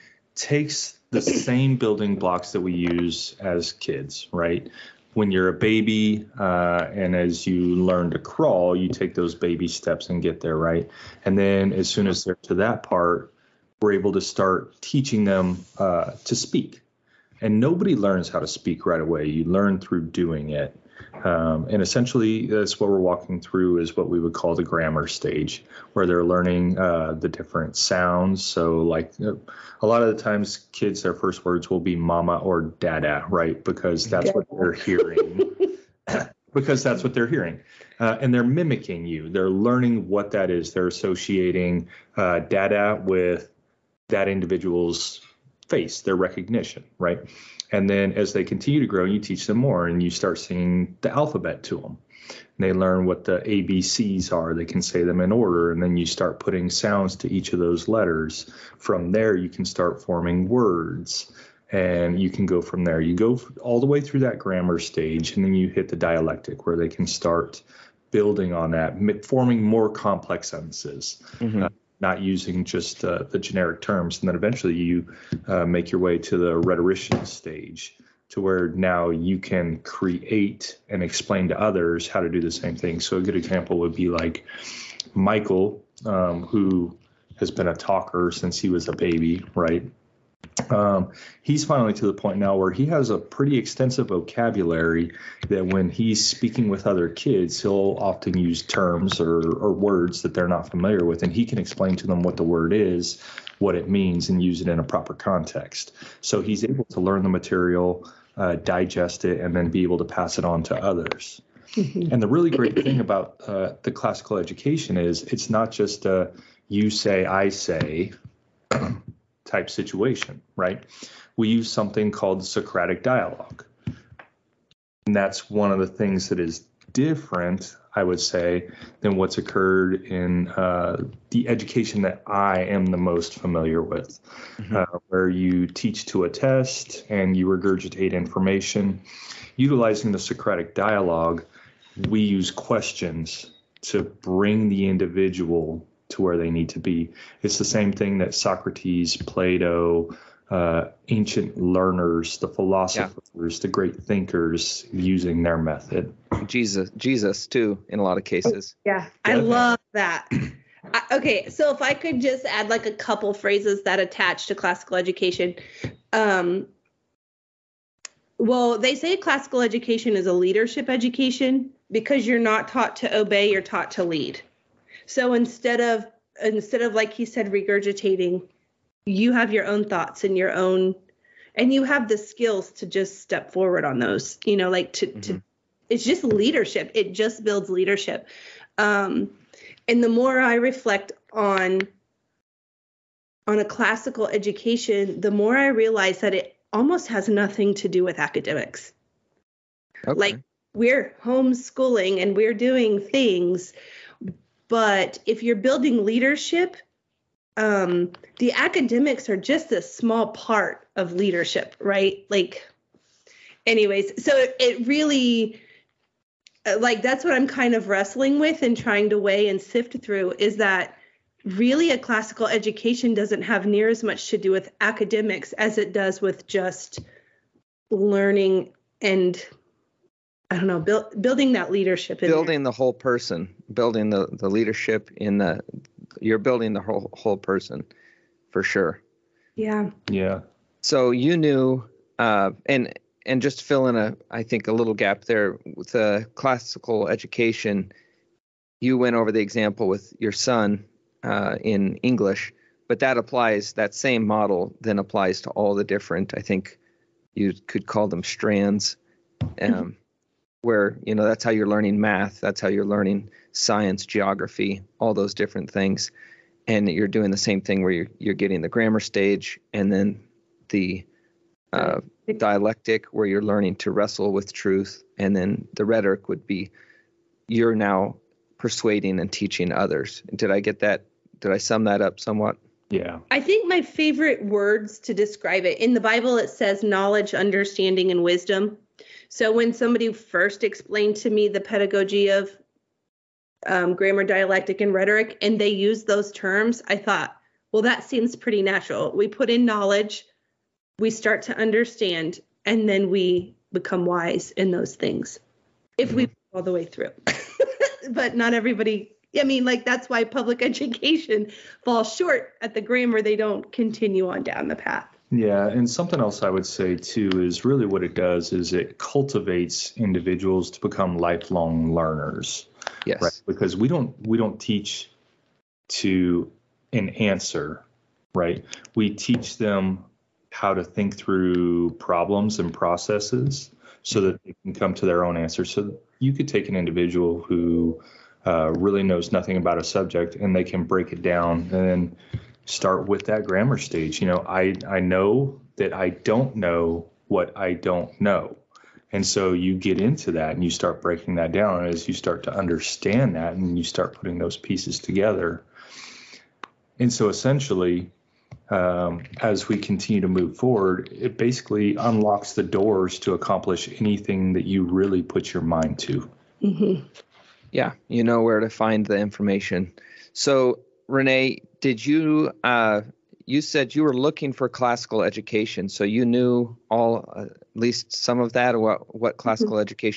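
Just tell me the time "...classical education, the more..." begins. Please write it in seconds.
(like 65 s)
193 s.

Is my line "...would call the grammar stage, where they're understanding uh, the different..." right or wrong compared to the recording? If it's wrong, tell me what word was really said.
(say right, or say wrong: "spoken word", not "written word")
wrong: "learning", not "understanding".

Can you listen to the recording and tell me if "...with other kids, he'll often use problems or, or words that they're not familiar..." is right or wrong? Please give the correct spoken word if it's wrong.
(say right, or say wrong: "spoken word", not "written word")
wrong: "terms", not "problems".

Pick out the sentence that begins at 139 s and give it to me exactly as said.
Utilizing the Socratic dialogue, we use questions to bring the individual to where they need to be.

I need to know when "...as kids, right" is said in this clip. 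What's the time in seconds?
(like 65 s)
3 s.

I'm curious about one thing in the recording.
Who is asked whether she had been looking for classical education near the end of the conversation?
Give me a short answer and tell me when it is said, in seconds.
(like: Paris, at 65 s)
Rawné, at 371 s.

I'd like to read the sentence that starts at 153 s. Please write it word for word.
the great thinkers using their method.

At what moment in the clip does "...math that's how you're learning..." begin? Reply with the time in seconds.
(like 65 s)
262 s.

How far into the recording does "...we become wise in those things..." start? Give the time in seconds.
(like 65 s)
303 s.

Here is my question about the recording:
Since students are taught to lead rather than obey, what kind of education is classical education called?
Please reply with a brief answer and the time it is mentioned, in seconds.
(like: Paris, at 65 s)
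leadership education, at 170 s.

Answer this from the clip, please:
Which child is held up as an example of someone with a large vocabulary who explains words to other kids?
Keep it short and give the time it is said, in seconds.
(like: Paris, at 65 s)
Michael, at 85 s.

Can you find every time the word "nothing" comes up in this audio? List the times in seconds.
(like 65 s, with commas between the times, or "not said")
197 s, 339 s.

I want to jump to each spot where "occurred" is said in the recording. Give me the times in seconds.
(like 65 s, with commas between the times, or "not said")
129 s.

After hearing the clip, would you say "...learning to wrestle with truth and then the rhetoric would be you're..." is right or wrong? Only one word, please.
right.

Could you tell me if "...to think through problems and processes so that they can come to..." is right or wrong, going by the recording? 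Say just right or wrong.
right.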